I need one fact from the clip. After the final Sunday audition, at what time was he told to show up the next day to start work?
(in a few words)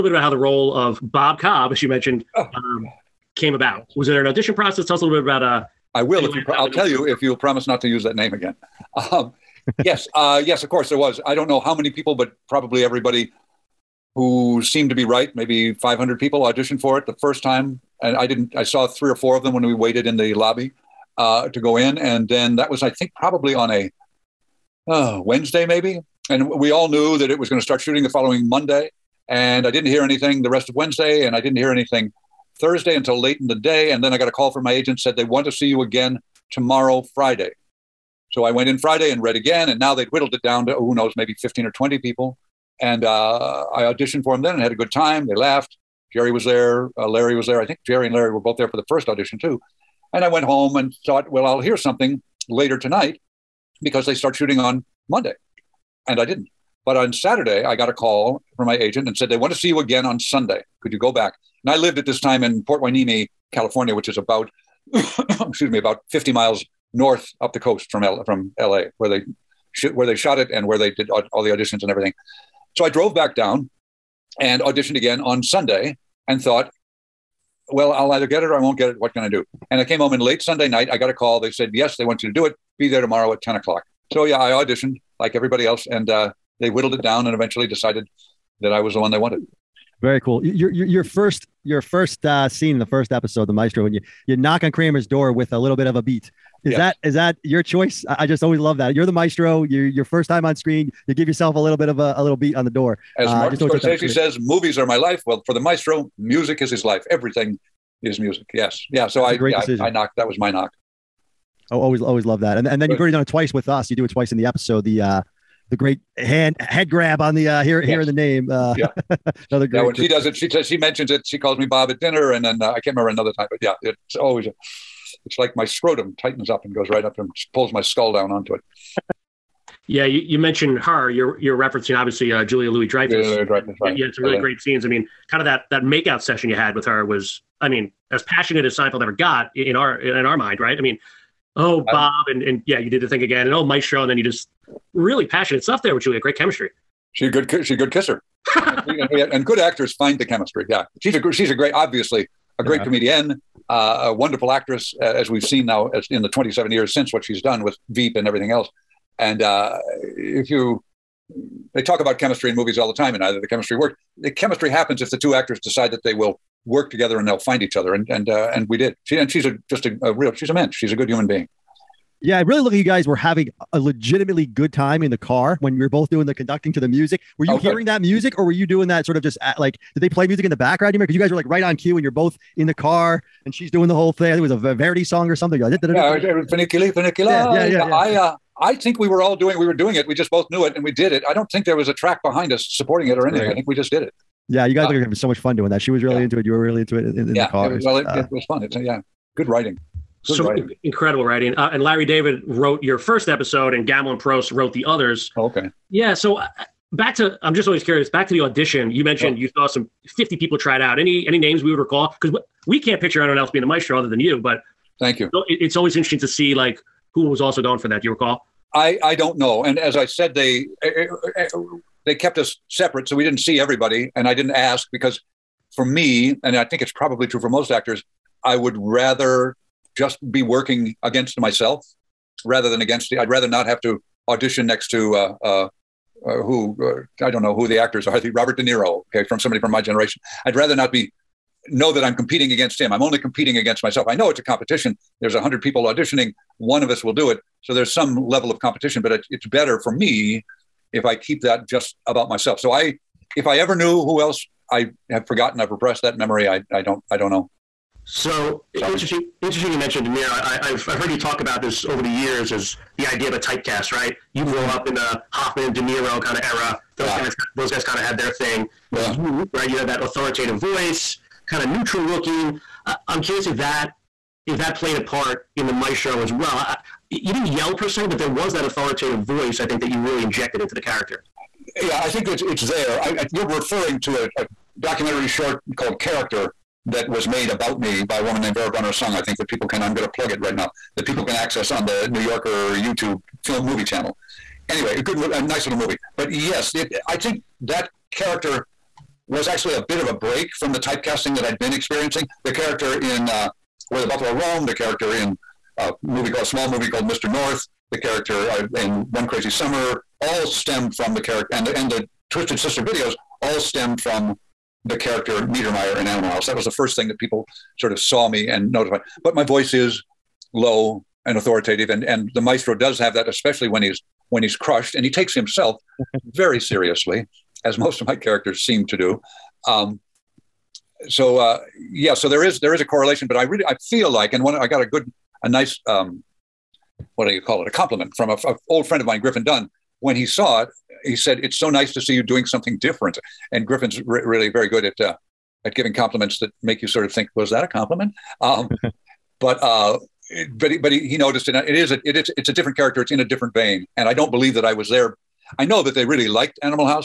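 10 o'clock.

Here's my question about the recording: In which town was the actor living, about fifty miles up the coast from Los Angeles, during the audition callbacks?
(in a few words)
Port Hueneme.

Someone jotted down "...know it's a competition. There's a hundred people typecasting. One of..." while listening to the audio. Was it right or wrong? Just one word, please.
wrong.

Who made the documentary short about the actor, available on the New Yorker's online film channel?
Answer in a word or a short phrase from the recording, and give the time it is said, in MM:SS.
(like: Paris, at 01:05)
Vera Brunner Sung, at 04:48.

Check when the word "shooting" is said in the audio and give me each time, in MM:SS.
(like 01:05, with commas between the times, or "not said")
00:27, 00:54.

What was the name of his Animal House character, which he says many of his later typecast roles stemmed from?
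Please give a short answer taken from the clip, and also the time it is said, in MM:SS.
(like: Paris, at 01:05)
Niedermeyer, at 05:15.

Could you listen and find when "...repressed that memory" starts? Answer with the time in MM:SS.
04:15.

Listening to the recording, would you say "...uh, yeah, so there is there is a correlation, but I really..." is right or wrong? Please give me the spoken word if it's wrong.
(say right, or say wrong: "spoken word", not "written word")
right.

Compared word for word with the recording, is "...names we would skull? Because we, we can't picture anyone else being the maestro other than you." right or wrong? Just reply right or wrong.
wrong.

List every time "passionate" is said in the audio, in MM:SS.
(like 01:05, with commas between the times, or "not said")
02:18, 02:25.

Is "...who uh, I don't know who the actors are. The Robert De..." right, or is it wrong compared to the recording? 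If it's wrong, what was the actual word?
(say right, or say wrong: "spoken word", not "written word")
right.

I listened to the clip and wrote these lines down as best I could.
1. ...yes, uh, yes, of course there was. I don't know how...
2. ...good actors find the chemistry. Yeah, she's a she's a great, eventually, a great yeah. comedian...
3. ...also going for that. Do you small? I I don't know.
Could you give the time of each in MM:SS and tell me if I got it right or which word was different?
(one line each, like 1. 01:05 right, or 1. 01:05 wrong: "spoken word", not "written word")
1. 00:09 right
2. 02:29 wrong: "obviously", not "eventually"
3. 03:37 wrong: "recall", not "small".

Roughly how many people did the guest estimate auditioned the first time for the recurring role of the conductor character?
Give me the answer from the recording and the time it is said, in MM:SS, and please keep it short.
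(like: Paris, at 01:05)
500, at 00:15.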